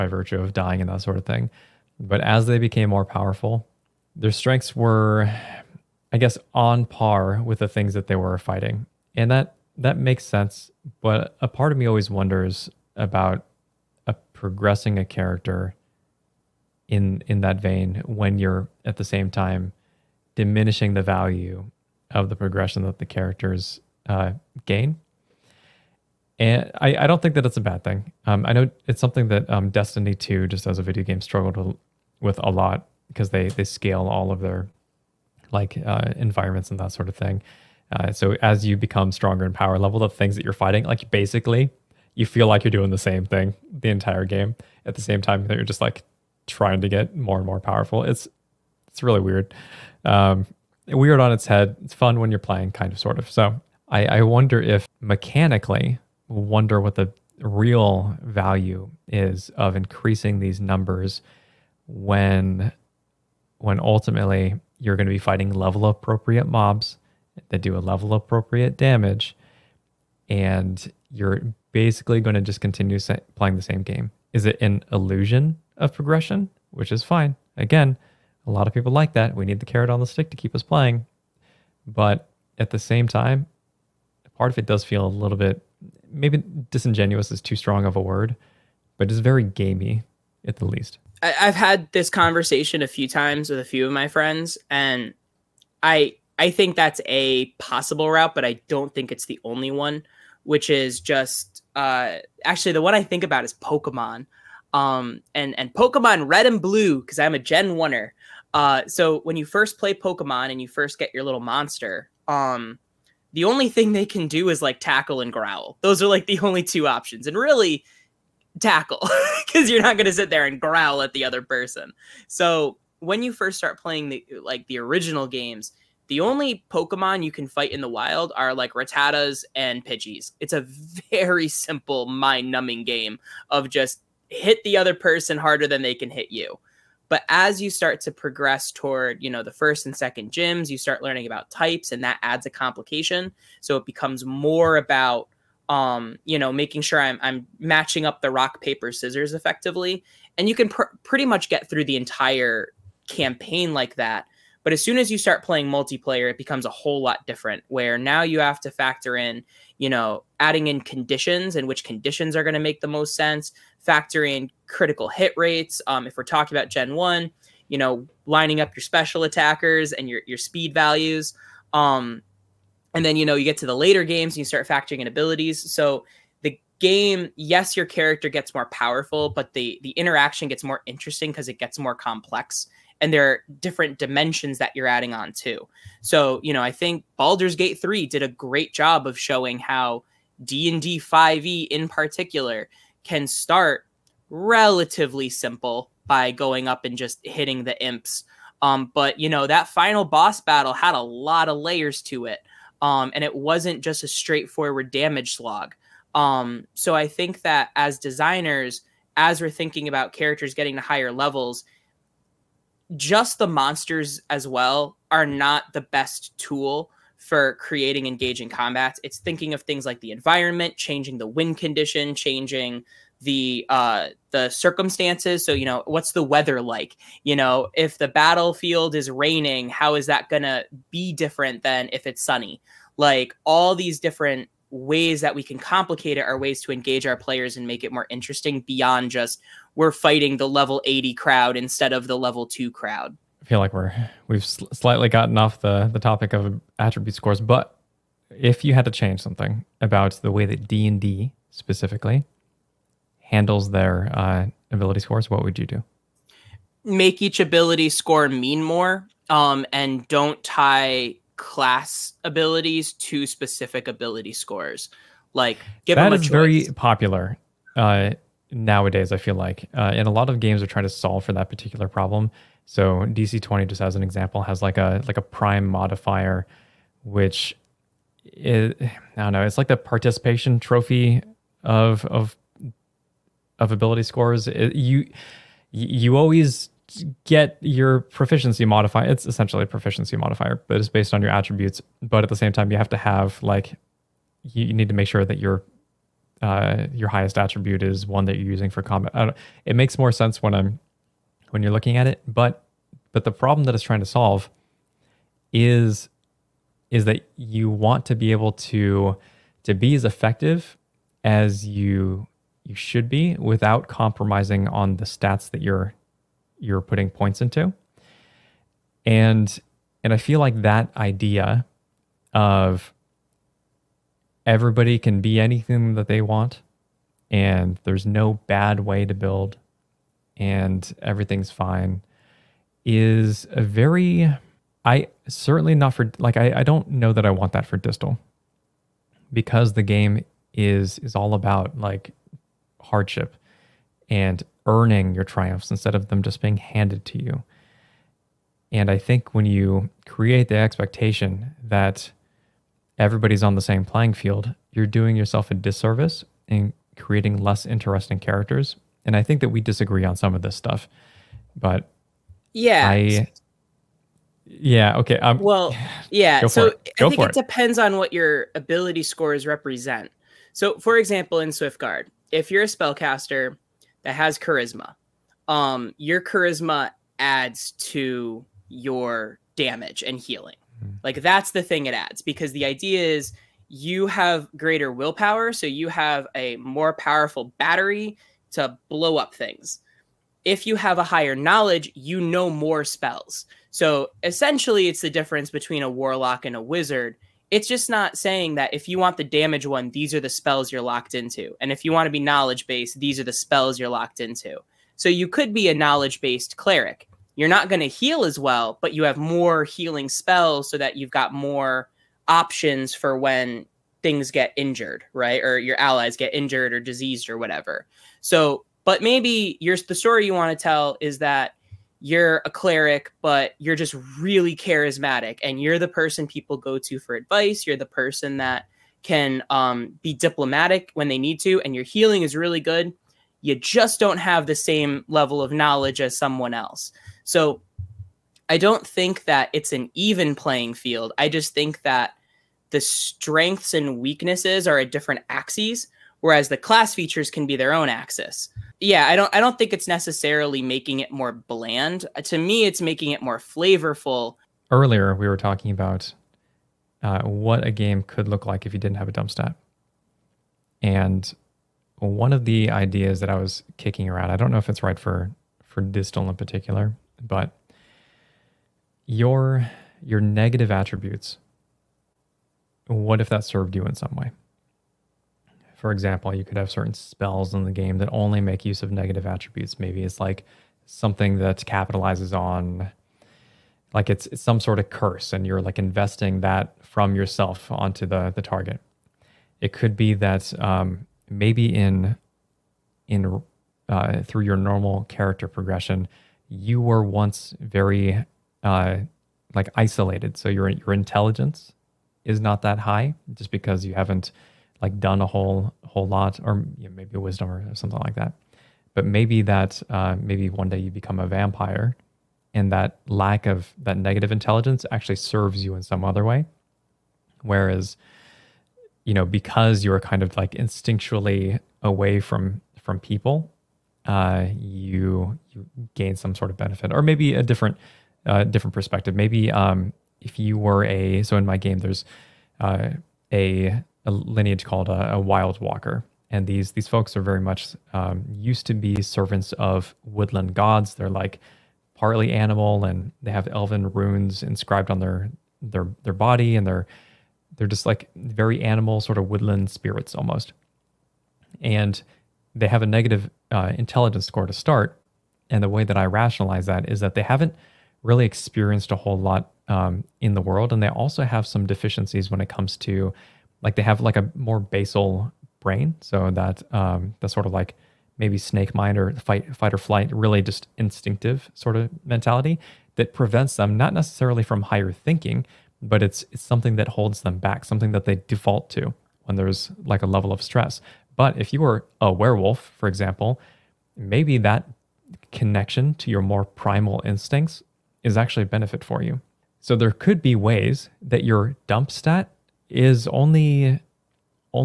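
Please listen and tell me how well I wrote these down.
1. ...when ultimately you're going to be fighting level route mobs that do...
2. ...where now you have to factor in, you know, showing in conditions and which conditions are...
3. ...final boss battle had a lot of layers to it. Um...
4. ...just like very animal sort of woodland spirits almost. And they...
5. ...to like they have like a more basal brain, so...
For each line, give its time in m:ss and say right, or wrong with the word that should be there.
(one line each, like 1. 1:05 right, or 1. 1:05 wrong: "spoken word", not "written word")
1. 1:03 wrong: "appropriate", not "route"
2. 2:37 wrong: "adding", not "showing"
3. 3:19 right
4. 9:07 right
5. 9:22 right.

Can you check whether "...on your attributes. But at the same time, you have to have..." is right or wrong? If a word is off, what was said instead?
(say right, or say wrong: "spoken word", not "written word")
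right.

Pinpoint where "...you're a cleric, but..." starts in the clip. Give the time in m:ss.
7:02.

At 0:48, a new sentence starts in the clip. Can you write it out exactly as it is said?
It's it's really weird, um, weird on its head.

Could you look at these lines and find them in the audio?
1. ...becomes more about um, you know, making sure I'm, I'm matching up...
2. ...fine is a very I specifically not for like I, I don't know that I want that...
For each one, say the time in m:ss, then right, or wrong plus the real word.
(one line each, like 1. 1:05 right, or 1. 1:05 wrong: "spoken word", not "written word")
1. 2:23 right
2. 5:31 wrong: "certainly", not "specifically".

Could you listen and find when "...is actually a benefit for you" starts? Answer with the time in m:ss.
9:48.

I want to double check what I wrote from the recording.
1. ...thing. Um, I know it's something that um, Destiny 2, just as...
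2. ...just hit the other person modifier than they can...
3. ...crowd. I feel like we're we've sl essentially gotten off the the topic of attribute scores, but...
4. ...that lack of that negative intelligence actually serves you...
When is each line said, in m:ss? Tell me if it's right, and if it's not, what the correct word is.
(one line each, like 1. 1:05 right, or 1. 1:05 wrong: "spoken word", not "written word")
1. 0:27 right
2. 2:13 wrong: "harder", not "modifier"
3. 4:02 wrong: "slightly", not "essentially"
4. 8:32 right.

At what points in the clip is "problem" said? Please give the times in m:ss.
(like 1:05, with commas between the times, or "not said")
4:31, 5:03.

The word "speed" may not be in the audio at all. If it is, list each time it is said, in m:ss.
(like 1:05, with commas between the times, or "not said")
2:50.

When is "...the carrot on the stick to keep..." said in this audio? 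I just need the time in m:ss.
1:19.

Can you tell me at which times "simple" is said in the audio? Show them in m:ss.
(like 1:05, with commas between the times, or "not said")
2:11, 3:15.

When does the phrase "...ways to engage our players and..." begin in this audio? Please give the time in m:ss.
3:56.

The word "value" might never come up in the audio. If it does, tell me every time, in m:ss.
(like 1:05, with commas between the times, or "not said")
0:21, 0:58, 2:50.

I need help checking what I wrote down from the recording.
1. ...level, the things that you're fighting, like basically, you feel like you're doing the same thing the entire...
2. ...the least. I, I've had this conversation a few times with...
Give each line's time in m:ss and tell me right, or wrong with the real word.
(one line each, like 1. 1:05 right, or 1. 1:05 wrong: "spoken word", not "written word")
1. 0:39 right
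2. 1:30 right.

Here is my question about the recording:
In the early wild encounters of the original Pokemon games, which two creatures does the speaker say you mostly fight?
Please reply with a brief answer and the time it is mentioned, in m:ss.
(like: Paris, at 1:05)
Rattatas and Pidgeys, at 2:08.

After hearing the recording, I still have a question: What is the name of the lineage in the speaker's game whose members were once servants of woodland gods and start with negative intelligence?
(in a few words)
wild walker.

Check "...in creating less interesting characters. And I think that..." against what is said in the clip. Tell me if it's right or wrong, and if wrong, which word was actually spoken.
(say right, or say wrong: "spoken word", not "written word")
right.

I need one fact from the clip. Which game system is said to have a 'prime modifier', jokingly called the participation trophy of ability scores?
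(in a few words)
DC twenty.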